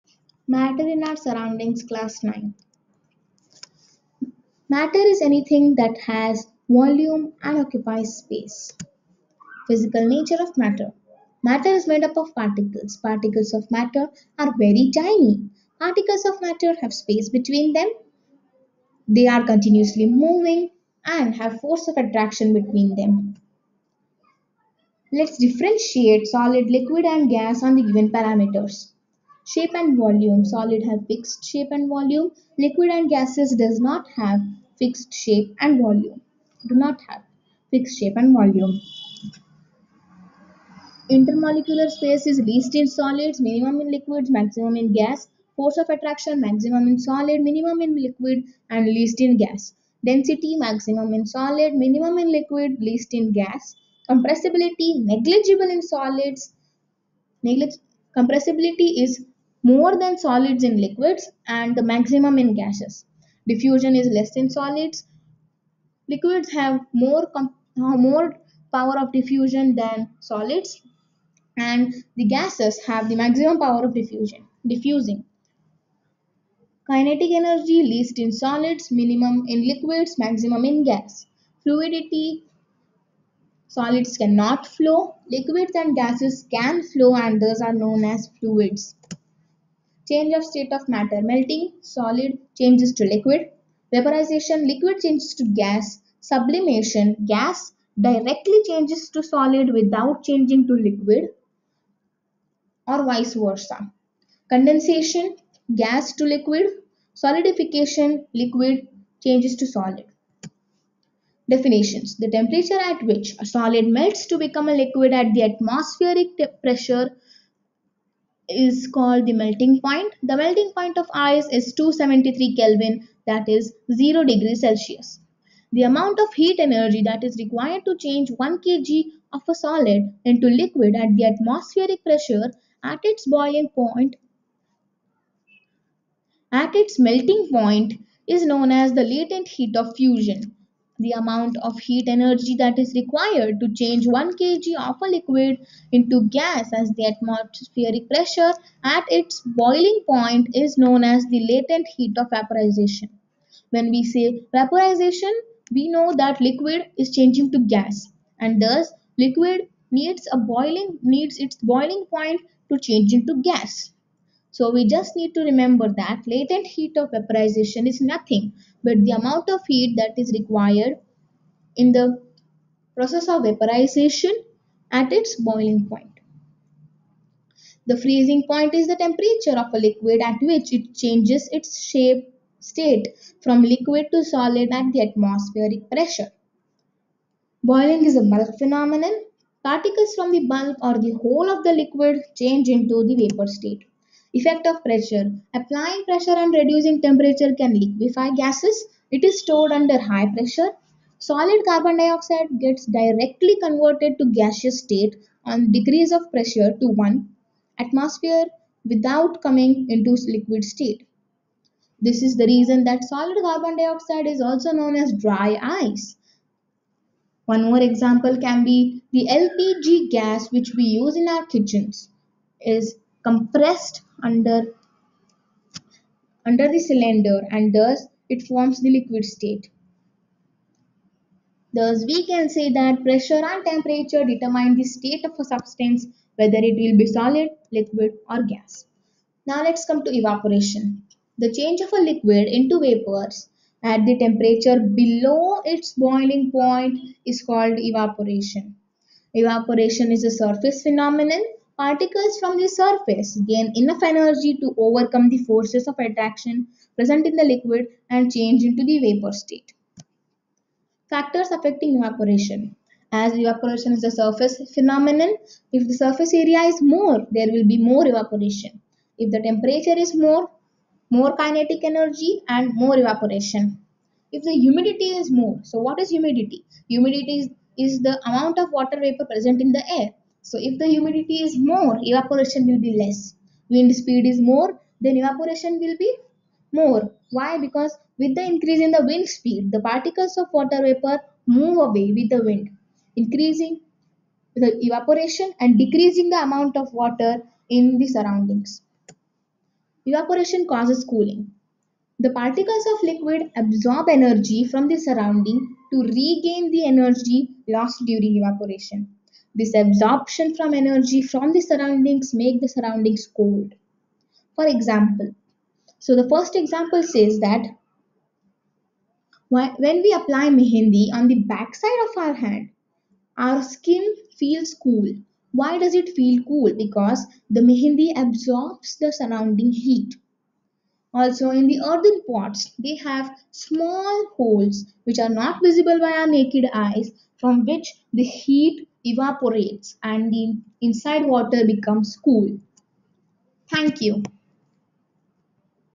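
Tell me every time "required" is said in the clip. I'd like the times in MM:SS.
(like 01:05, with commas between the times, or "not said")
02:07, 02:22, 02:50.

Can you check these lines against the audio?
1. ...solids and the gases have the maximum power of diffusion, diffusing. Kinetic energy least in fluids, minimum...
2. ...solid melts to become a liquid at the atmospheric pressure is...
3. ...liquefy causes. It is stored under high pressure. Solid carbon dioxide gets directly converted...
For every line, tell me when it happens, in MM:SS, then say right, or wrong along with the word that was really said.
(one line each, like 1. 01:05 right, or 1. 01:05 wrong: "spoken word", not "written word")
1. 01:10 wrong: "solids", not "fluids"
2. 01:53 right
3. 03:17 wrong: "gases", not "causes".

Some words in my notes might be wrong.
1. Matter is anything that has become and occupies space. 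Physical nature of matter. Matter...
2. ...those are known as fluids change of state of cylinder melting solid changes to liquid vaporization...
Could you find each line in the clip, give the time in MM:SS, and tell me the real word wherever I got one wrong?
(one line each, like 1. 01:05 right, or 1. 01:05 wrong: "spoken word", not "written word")
1. 00:04 wrong: "volume", not "become"
2. 01:27 wrong: "matter", not "cylinder".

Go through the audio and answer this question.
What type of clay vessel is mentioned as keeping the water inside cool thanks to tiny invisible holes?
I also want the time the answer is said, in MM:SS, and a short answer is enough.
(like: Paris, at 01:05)
Earthen pots, at 05:31.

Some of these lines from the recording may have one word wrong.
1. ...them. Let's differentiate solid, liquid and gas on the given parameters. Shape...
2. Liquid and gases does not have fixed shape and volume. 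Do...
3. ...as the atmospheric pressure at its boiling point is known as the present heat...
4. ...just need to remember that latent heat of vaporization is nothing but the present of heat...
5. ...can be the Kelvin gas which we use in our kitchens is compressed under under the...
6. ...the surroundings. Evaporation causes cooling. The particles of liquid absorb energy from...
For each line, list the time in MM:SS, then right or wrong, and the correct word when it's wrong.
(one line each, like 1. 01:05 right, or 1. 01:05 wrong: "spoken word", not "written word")
1. 00:22 right
2. 00:32 right
3. 02:26 wrong: "latent", not "present"
4. 02:44 wrong: "amount", not "present"
5. 03:38 wrong: "LPG", not "Kelvin"
6. 04:57 right.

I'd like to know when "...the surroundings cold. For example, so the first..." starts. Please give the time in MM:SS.
05:12.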